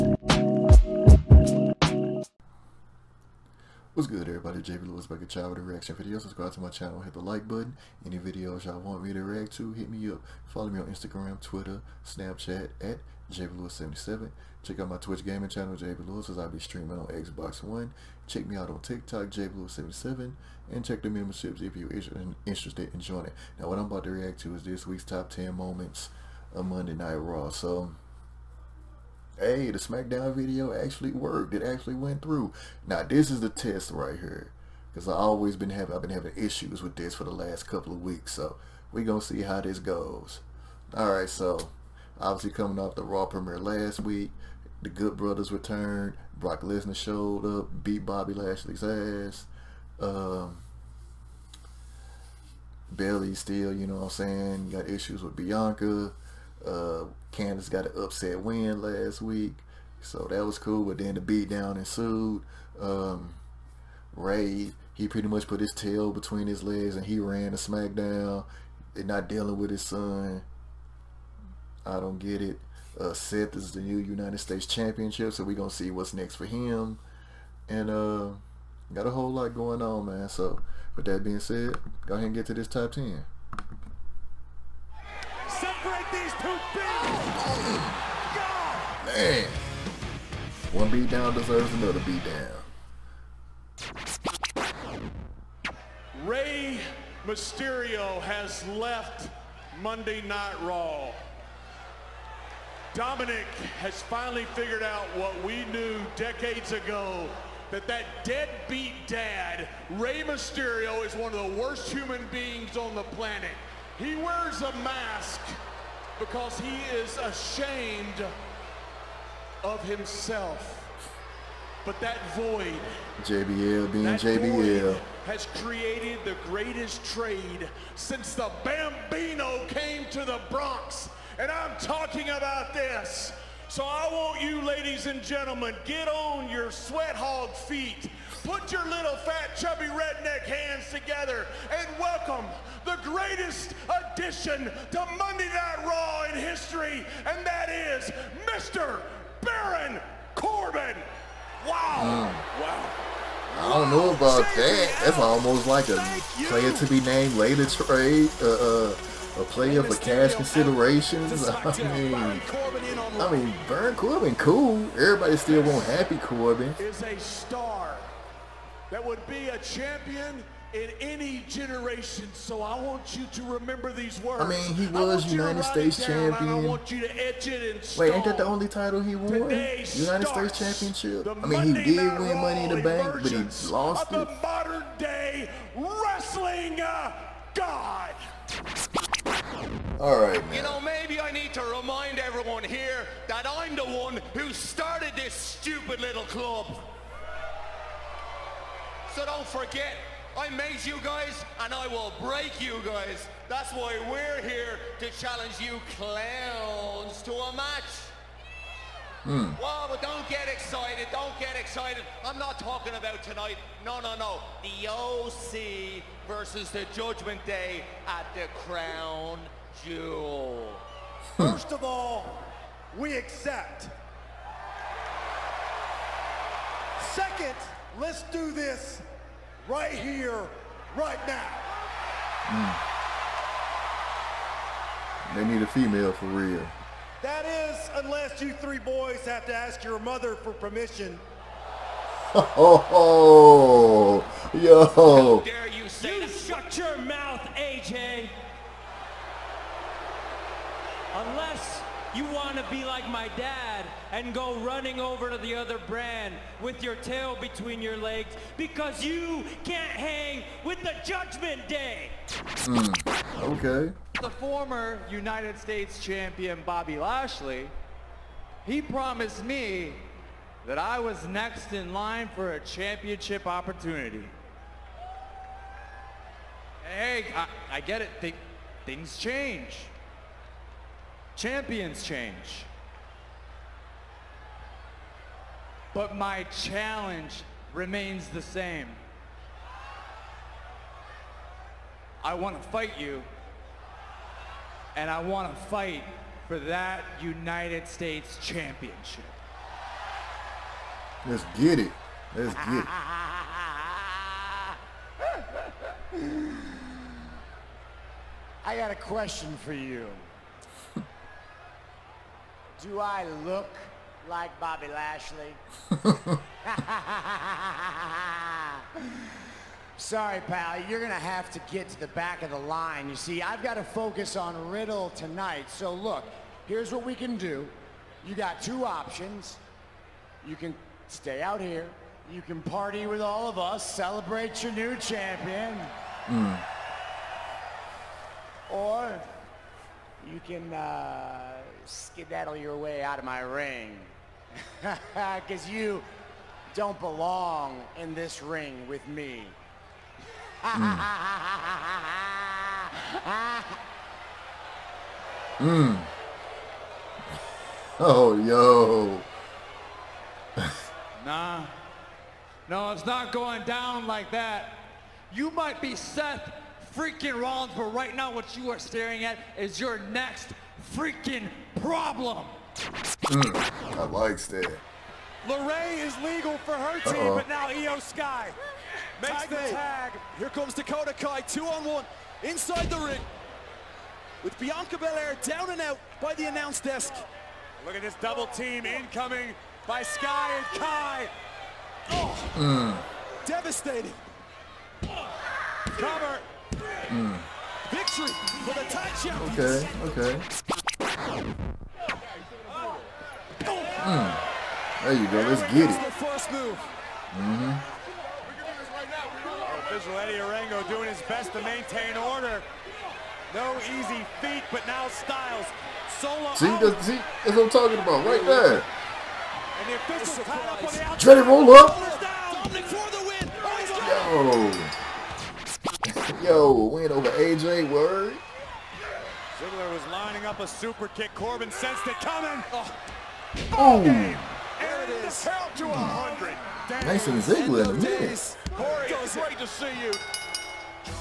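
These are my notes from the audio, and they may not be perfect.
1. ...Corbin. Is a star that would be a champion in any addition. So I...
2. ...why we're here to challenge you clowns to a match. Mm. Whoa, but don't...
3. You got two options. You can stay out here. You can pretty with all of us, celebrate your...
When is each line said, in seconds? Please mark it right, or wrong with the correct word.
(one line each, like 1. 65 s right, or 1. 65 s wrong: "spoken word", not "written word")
1. 166 s wrong: "generation", not "addition"
2. 203 s right
3. 328 s wrong: "party", not "pretty".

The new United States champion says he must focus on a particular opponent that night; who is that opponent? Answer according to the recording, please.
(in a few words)
Riddle.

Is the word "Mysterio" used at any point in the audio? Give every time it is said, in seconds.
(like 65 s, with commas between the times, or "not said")
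97 s, 110 s.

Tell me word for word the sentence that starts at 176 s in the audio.
Wait, ain't that the only title he won?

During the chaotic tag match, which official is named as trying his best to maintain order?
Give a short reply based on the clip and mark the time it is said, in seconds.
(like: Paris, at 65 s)
Eddie Orengo, at 410 s.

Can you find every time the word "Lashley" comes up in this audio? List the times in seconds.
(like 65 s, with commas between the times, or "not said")
48 s, 266 s, 314 s.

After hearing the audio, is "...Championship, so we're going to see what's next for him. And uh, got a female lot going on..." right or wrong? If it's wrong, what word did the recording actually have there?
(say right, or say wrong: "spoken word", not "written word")
wrong: "whole", not "female".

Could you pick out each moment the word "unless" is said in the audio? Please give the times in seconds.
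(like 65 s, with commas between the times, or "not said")
237 s, 251 s.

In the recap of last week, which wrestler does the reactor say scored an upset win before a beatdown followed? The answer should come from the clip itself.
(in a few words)
Candice.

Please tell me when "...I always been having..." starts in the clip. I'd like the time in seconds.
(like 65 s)
35 s.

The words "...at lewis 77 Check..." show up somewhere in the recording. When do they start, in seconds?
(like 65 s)
12 s.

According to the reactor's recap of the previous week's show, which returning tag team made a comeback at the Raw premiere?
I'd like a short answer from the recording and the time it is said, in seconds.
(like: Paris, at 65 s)
The Good Brothers, at 44 s.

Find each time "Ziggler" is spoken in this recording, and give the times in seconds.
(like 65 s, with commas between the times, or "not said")
429 s, 437 s.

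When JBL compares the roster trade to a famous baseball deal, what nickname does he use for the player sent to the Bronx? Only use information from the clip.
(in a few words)
the Bambino.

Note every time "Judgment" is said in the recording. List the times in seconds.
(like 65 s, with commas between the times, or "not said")
216 s, 261 s.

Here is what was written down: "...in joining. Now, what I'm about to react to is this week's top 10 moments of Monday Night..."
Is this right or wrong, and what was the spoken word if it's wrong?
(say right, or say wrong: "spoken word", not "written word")
right.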